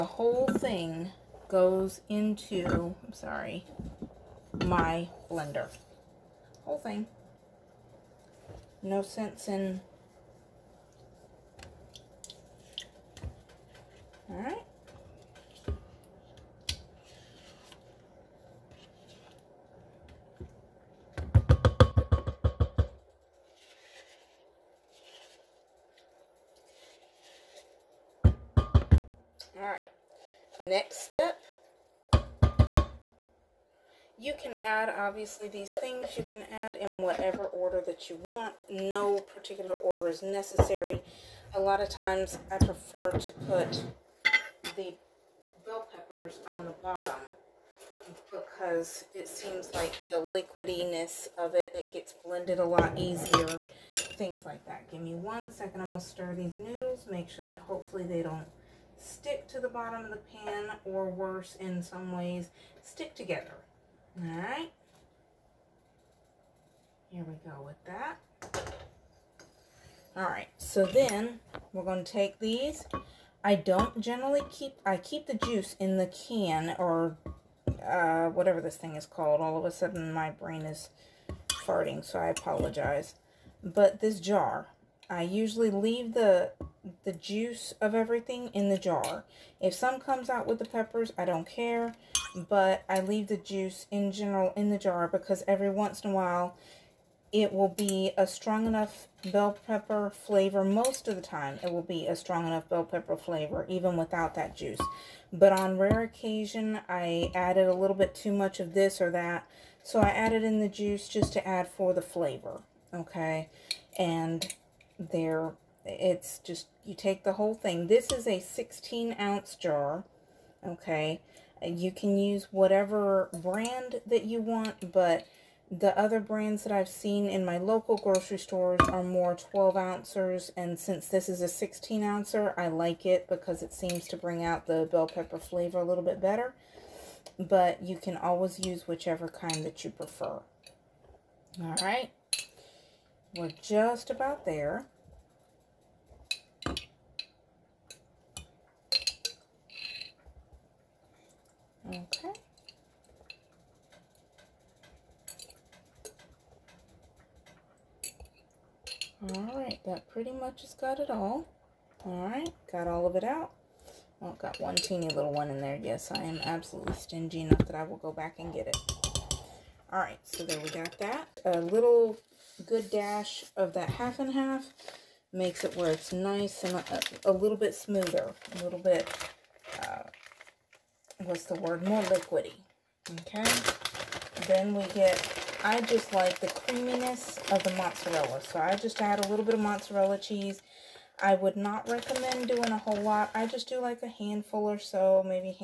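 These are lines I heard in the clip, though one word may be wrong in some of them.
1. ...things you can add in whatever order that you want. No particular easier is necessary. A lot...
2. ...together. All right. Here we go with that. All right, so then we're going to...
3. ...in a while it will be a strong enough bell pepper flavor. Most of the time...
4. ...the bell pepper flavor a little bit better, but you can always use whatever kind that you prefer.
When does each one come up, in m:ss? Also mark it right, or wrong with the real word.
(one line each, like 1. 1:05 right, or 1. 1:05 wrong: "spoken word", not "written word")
1. 0:35 wrong: "order", not "easier"
2. 1:03 right
3. 1:36 right
4. 2:14 wrong: "whichever", not "whatever".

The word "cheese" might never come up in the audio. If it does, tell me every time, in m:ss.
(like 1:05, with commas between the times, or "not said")
3:10.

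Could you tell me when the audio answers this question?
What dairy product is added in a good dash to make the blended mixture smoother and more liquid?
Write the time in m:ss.
2:53.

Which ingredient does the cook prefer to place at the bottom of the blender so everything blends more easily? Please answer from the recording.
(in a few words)
bell peppers.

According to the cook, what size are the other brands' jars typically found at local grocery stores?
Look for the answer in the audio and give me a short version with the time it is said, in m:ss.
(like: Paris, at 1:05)
12 ounces, at 2:09.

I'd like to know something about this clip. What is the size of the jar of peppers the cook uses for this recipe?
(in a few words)
16 ounces.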